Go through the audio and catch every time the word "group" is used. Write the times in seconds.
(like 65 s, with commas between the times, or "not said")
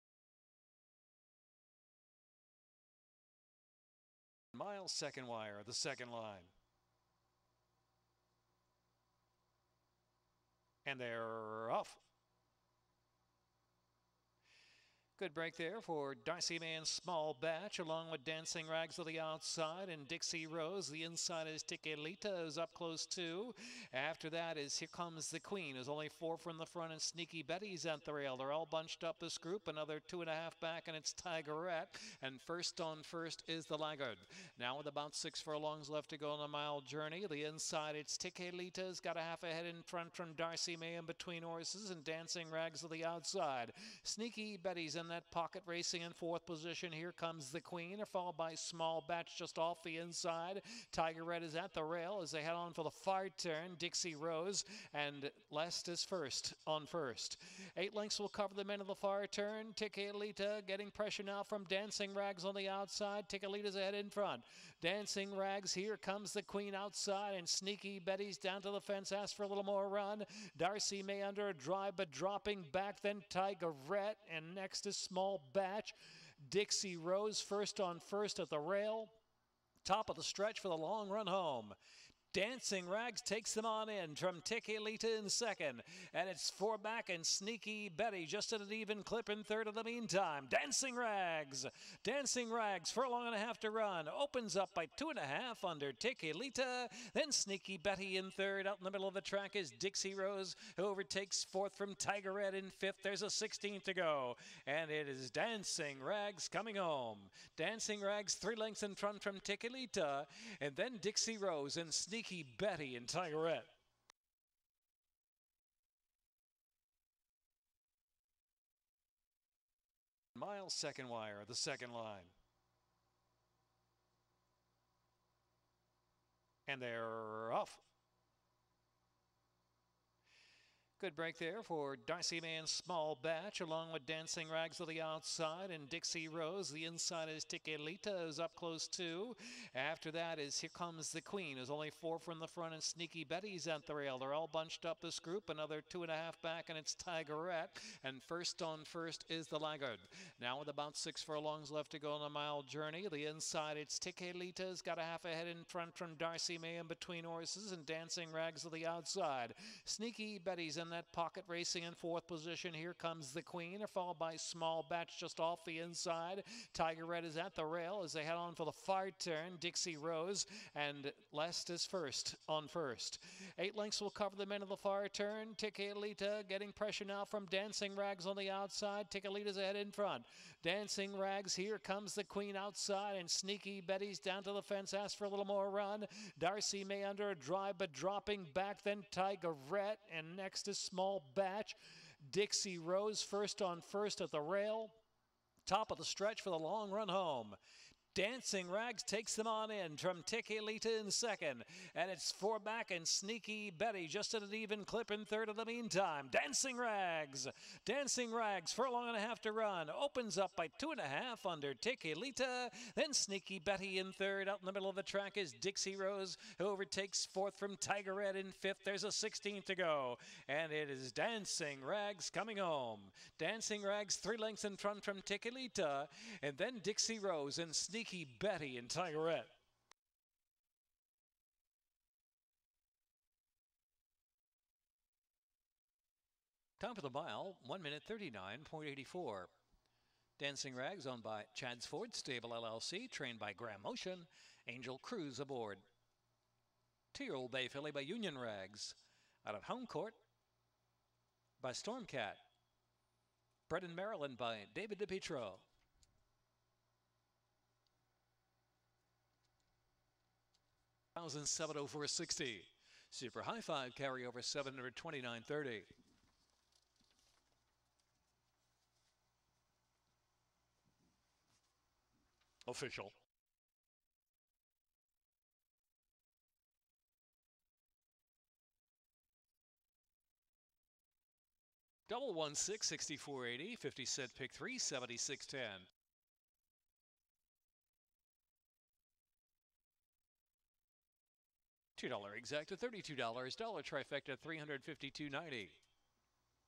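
29 s, 145 s.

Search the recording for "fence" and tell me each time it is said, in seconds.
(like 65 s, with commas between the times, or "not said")
68 s, 184 s.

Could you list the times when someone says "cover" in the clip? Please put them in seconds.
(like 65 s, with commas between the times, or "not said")
58 s, 174 s.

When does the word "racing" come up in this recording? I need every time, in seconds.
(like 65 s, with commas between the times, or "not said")
45 s, 161 s.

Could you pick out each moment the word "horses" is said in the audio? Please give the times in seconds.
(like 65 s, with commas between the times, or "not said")
41 s, 157 s.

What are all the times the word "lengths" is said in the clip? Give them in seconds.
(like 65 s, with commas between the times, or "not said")
57 s, 108 s, 173 s, 224 s.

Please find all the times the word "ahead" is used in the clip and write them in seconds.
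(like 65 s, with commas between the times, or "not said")
39 s, 63 s, 155 s, 179 s.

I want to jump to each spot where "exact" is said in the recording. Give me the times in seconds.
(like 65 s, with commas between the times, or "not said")
292 s.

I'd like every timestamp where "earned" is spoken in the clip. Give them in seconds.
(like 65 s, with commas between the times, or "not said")
not said.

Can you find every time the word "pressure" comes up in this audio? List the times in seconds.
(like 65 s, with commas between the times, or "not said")
60 s, 176 s.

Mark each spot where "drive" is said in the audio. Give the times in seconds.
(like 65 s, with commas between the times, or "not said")
71 s, 187 s.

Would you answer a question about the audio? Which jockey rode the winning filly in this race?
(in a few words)
Angel Cruz.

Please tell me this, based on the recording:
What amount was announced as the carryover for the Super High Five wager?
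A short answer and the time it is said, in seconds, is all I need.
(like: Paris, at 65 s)
729.30, at 264 s.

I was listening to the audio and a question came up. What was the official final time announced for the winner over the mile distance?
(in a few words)
1:39.84.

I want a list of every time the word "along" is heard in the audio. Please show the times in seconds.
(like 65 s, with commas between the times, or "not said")
17 s, 133 s.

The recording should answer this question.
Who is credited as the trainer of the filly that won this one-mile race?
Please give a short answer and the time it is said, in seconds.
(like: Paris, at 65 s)
Graham Motion, at 243 s.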